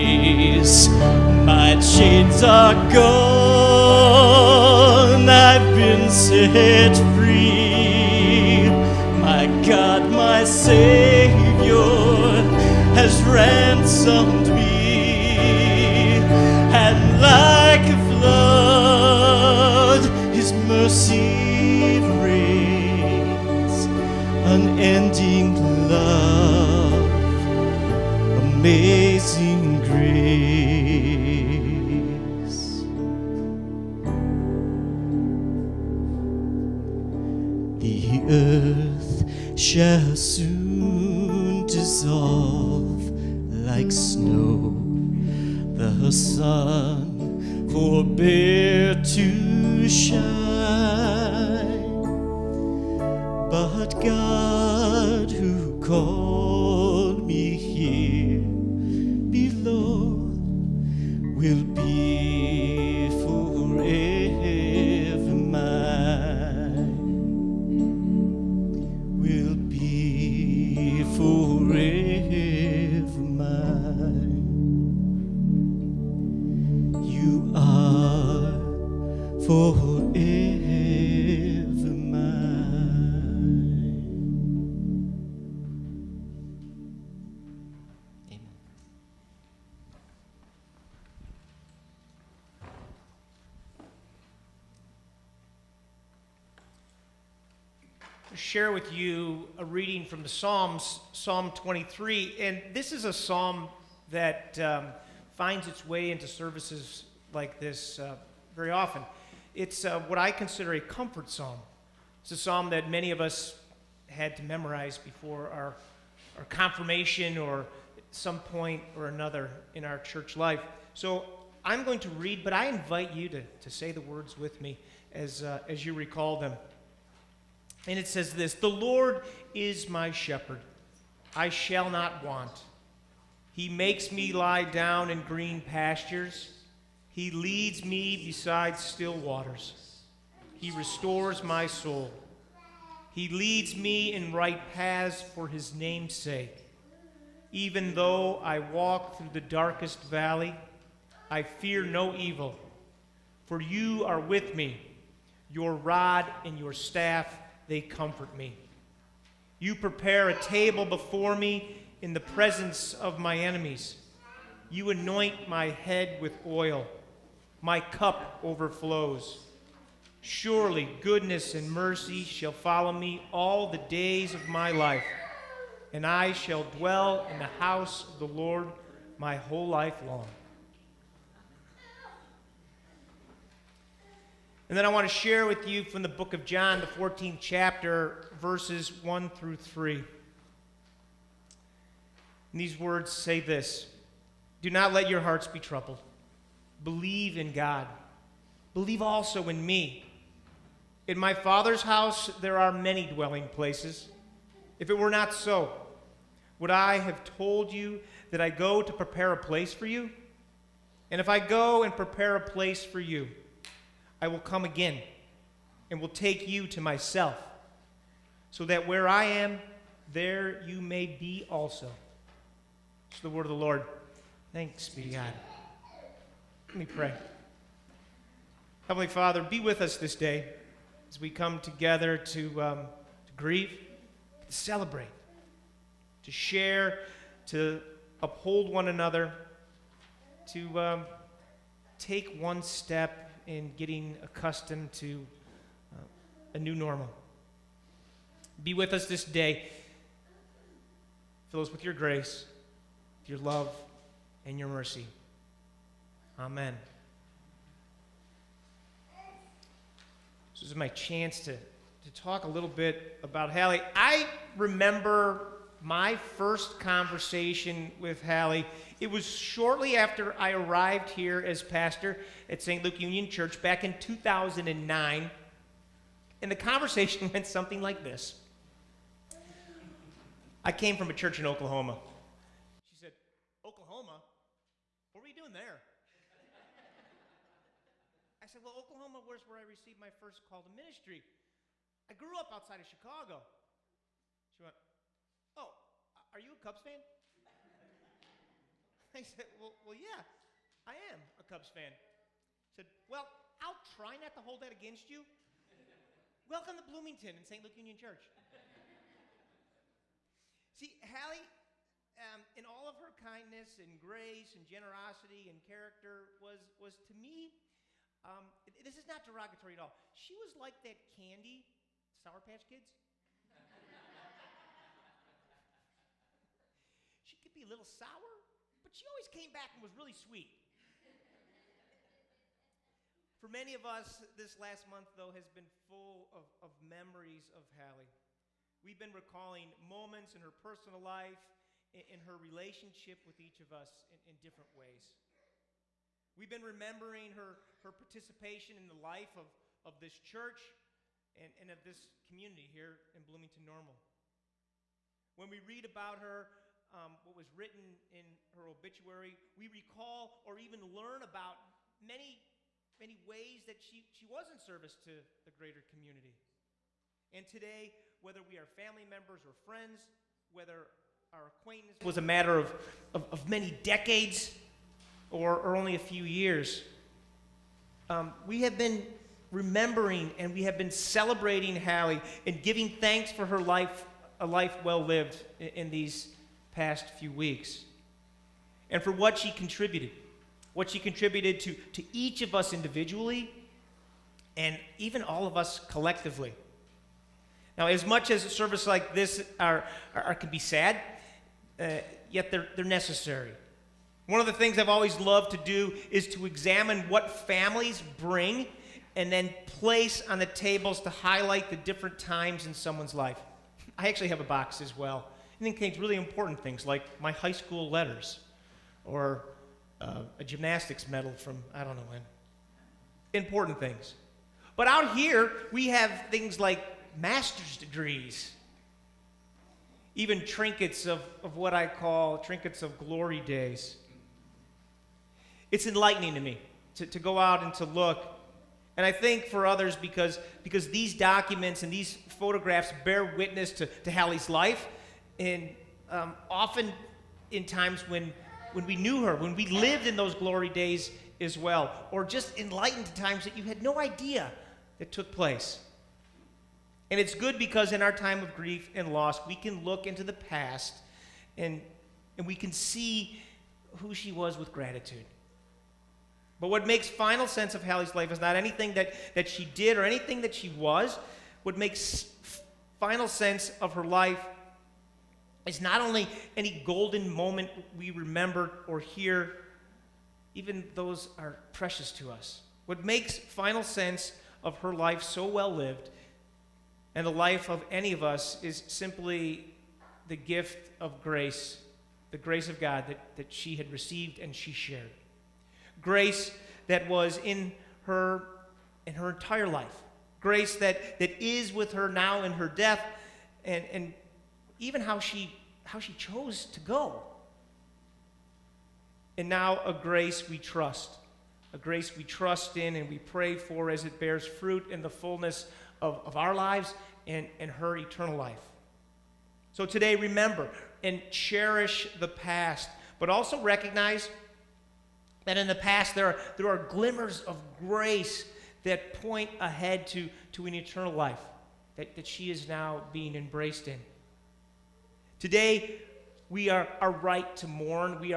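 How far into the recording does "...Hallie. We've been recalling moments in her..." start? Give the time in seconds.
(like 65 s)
337 s.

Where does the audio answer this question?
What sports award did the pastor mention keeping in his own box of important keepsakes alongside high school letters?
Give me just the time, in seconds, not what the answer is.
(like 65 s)
420 s.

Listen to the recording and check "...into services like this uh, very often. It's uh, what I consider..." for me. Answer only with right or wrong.
right.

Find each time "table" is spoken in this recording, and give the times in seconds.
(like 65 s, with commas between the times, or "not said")
160 s, 410 s.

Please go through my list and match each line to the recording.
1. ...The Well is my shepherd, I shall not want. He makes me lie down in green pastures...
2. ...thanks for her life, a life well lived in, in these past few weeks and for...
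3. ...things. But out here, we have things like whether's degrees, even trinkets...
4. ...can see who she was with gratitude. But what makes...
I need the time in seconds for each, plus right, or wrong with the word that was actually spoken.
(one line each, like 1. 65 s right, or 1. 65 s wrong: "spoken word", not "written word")
1. 128 s wrong: "Lord", not "Well"
2. 382 s right
3. 423 s wrong: "master", not "whether"
4. 462 s right.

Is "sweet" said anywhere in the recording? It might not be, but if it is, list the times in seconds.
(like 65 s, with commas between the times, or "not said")
330 s.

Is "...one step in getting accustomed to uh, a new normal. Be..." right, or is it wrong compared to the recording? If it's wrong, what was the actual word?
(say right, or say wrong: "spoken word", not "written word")
right.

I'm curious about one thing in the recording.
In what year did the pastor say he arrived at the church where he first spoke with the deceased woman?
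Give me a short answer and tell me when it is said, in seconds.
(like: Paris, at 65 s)
2009, at 273 s.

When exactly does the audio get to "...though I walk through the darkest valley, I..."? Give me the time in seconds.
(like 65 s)
147 s.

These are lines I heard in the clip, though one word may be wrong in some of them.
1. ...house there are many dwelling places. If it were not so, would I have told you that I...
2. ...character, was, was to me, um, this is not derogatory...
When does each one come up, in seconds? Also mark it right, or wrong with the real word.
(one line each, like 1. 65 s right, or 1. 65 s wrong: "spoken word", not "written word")
1. 201 s right
2. 315 s right.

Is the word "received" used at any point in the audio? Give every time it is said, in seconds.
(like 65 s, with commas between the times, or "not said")
289 s, 493 s.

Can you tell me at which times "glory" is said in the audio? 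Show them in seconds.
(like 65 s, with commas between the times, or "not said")
432 s, 450 s.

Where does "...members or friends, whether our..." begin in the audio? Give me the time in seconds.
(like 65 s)
369 s.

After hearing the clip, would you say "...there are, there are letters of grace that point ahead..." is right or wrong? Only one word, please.
wrong.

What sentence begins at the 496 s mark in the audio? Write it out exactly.
Grace that was in her in her entire life.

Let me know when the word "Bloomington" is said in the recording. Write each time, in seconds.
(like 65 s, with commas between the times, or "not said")
306 s, 353 s.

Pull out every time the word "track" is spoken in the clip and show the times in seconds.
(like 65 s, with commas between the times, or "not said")
not said.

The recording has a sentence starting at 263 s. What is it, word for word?
I remember my first conversation with Hallie.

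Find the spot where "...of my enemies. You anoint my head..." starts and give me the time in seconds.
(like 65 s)
162 s.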